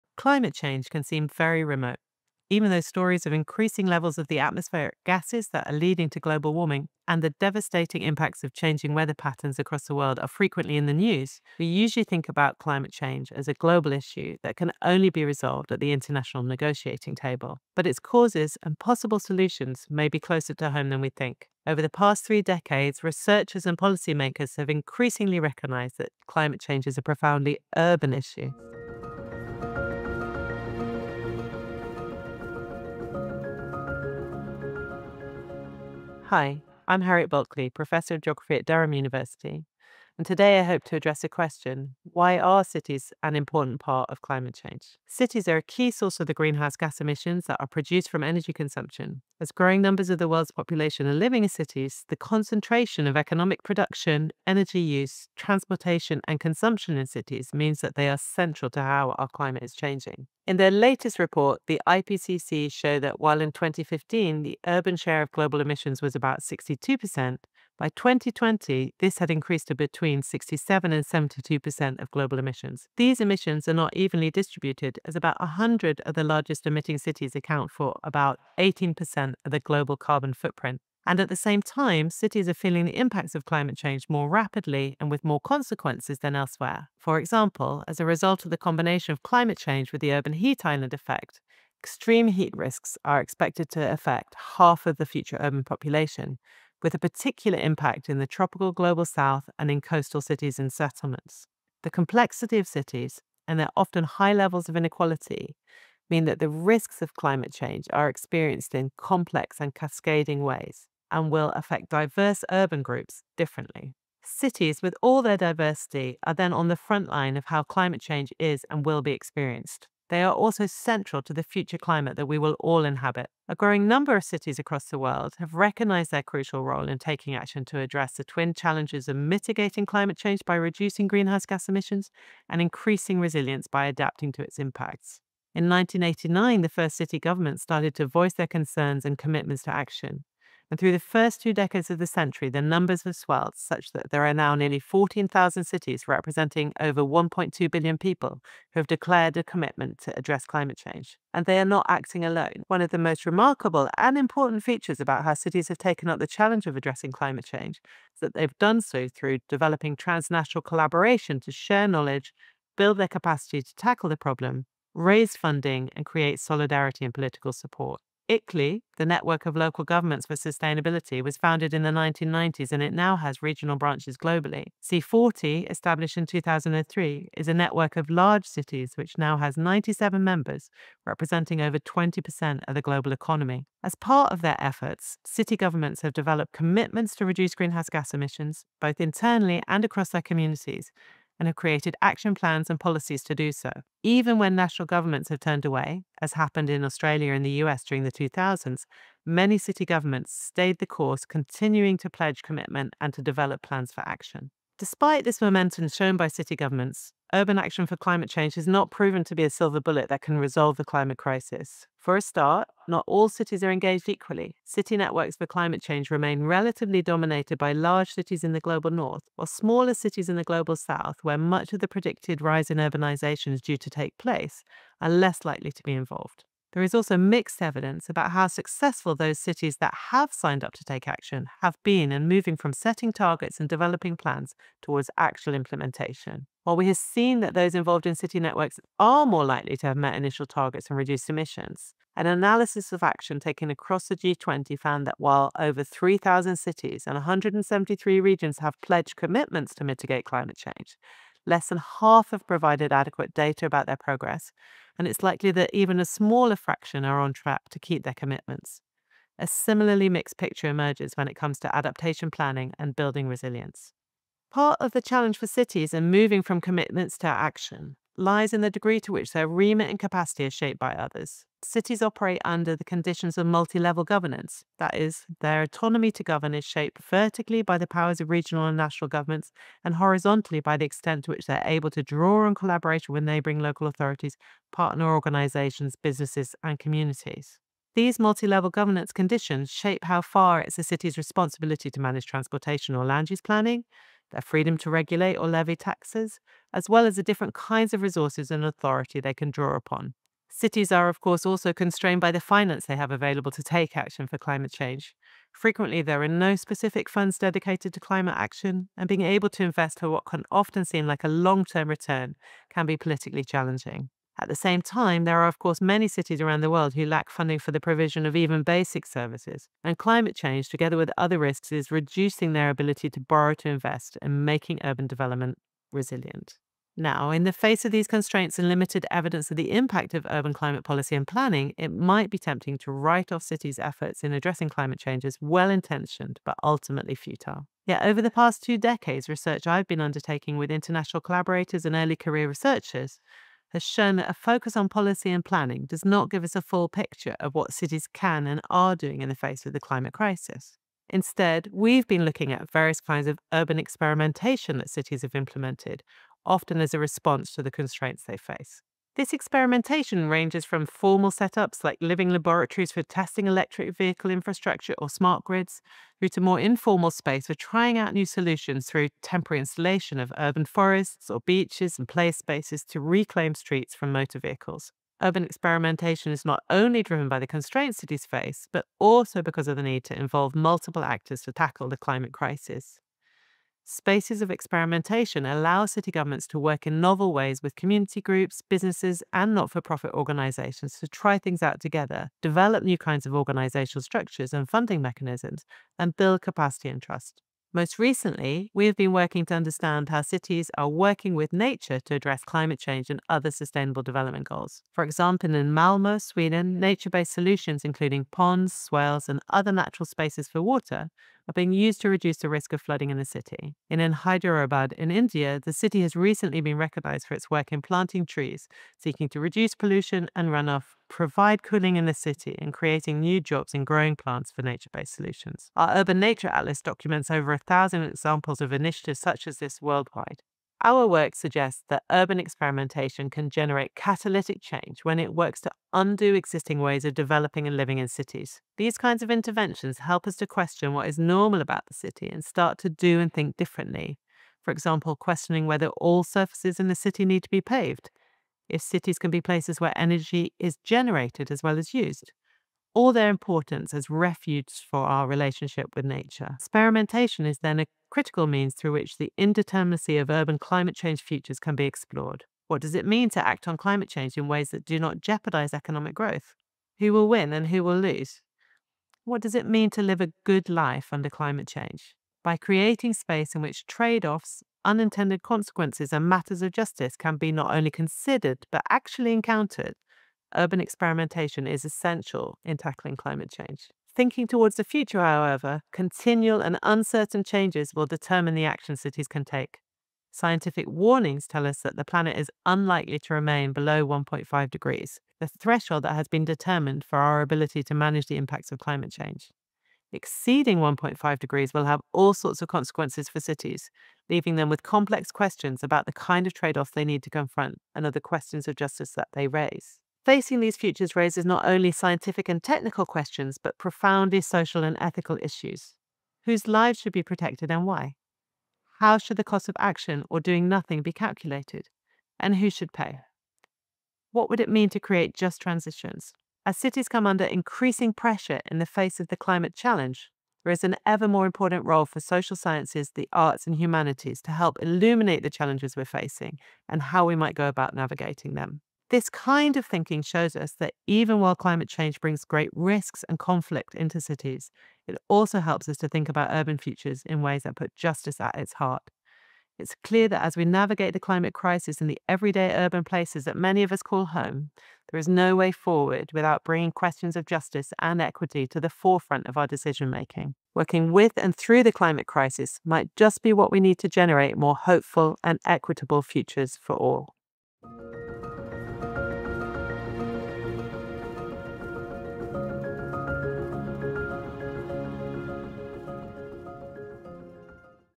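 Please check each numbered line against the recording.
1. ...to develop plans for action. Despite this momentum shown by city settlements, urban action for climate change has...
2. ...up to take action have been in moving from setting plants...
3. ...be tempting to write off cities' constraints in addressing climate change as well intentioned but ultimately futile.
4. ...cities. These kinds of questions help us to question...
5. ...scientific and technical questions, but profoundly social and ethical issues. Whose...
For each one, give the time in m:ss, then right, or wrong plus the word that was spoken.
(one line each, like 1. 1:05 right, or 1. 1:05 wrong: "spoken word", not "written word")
1. 3:23 wrong: "governments", not "settlements"
2. 3:50 wrong: "targets", not "plants"
3. 5:32 wrong: "efforts", not "constraints"
4. 7:18 wrong: "interventions", not "questions"
5. 8:31 right.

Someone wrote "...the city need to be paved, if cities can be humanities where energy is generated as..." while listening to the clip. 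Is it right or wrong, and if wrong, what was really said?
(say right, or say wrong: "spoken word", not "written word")
wrong: "places", not "humanities".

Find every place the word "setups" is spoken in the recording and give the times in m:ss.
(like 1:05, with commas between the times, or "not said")
6:01.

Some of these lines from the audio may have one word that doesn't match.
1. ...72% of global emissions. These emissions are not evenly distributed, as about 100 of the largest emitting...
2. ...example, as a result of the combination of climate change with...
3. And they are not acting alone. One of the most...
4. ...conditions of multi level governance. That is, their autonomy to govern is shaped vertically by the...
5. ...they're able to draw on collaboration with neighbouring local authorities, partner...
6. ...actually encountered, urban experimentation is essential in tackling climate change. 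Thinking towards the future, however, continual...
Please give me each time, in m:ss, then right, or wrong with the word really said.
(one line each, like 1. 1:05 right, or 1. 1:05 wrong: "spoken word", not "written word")
1. 1:11 right
2. 1:27 right
3. 2:31 right
4. 4:32 right
5. 4:41 right
6. 7:58 right.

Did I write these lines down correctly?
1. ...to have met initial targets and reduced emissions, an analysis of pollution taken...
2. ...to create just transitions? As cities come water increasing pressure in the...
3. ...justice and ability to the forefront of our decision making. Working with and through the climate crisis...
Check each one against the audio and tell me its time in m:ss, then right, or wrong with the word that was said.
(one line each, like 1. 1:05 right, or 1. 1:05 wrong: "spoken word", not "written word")
1. 3:59 wrong: "action", not "pollution"
2. 8:44 wrong: "under", not "water"
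3. 9:17 wrong: "equity", not "ability".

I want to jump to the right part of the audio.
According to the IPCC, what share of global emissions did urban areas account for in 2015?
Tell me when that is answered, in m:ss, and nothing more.
1:06.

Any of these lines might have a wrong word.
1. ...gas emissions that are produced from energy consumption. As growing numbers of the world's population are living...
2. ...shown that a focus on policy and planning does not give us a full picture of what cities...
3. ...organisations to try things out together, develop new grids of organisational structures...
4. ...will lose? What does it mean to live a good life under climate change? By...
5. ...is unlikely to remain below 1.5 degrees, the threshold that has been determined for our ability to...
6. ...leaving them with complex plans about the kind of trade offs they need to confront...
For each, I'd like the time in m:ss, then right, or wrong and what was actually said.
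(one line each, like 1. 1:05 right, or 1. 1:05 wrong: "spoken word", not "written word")
1. 0:46 right
2. 5:43 right
3. 6:30 wrong: "kinds", not "grids"
4. 7:47 right
5. 8:12 right
6. 8:24 wrong: "questions", not "plans".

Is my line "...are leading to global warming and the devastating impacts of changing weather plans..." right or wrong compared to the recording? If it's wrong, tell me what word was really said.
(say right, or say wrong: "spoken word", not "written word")
wrong: "patterns", not "plans".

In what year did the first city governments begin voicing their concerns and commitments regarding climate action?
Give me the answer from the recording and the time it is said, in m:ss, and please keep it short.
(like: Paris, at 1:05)
1989, at 2:15.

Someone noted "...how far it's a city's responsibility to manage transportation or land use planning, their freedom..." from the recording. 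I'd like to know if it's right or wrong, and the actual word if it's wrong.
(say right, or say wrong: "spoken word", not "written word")
right.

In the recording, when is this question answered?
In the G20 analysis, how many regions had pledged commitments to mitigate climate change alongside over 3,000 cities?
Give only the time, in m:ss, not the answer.
4:07.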